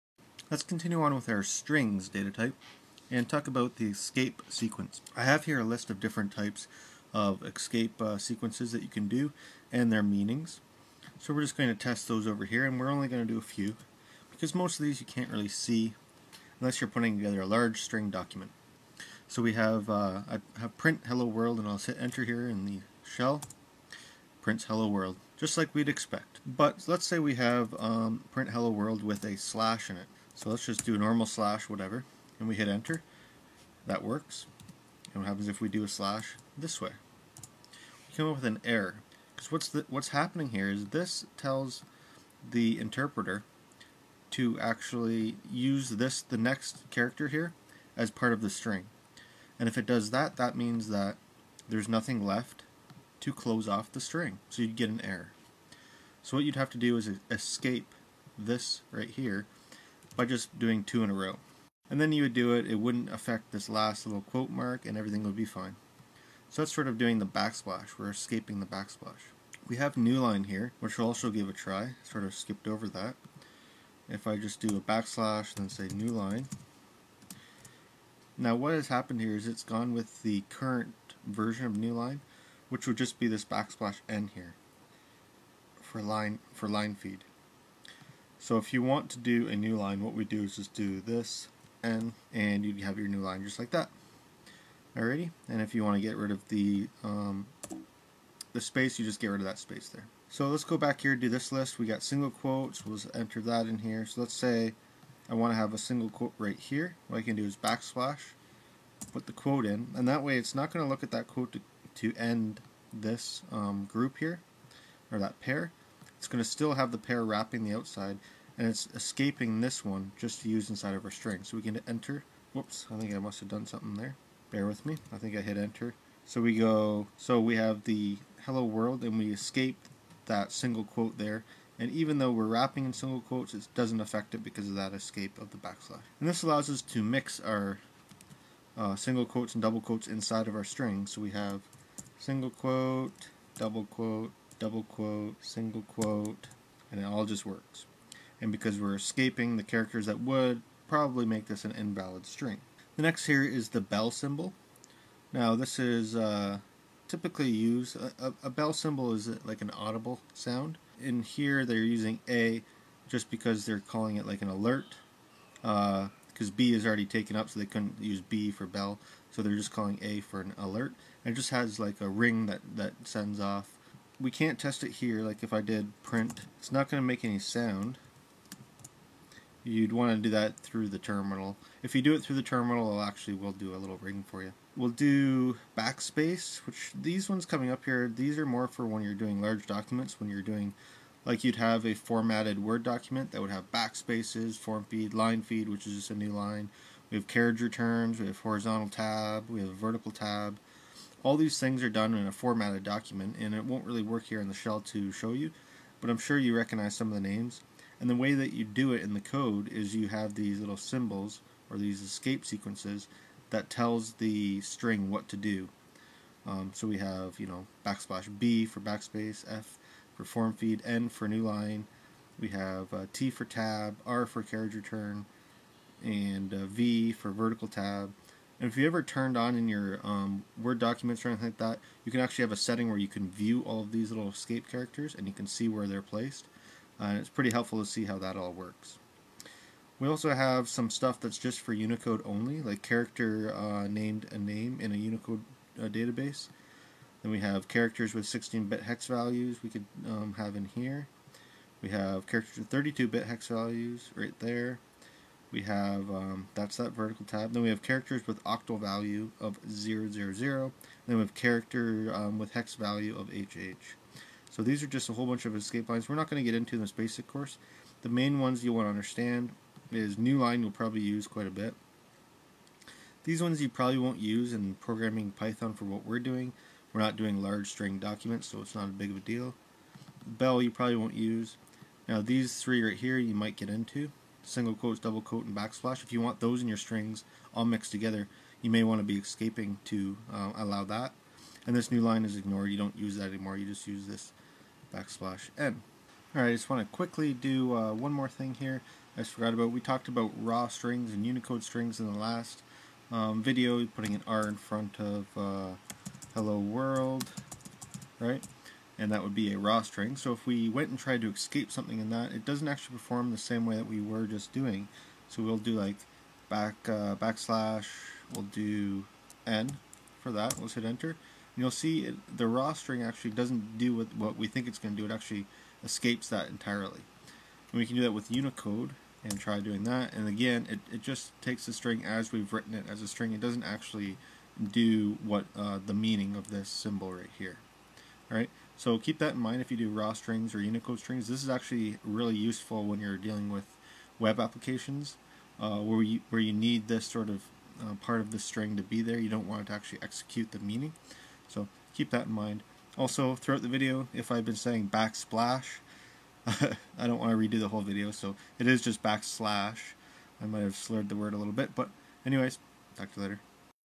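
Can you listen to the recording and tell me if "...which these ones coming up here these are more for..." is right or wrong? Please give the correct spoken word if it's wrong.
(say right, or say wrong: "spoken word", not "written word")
right.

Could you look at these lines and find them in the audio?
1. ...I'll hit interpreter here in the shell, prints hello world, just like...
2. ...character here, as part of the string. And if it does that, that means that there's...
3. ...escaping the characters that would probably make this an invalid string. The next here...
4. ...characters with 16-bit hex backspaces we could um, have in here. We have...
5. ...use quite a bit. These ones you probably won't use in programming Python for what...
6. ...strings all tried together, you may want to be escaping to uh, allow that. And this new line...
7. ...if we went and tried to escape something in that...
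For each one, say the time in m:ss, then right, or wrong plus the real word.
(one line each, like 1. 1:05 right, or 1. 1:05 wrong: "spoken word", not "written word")
1. 0:21 wrong: "enter", not "interpreter"
2. 0:46 right
3. 2:28 right
4. 4:07 wrong: "values", not "backspaces"
5. 4:31 right
6. 4:46 wrong: "mixed", not "tried"
7. 5:10 right.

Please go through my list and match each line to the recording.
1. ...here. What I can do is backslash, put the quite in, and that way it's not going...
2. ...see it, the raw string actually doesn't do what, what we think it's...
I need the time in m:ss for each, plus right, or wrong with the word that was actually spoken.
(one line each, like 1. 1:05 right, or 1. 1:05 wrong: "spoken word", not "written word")
1. 1:46 wrong: "quote", not "quite"
2. 5:21 right.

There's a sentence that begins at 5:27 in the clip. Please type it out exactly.
And we can do that with Unicode and try doing that.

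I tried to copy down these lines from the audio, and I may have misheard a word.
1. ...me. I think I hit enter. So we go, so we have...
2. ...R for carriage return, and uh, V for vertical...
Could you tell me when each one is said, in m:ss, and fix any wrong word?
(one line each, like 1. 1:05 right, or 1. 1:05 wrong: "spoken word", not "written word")
1. 2:04 right
2. 3:44 right.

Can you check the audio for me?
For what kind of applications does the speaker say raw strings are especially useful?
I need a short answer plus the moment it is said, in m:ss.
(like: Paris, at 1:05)
Web applications, at 5:44.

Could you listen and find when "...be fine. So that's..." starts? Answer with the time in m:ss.
1:05.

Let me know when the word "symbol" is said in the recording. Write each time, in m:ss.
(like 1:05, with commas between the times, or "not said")
2:34, 2:38, 3:30, 5:36.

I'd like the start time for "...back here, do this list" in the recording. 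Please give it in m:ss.
1:40.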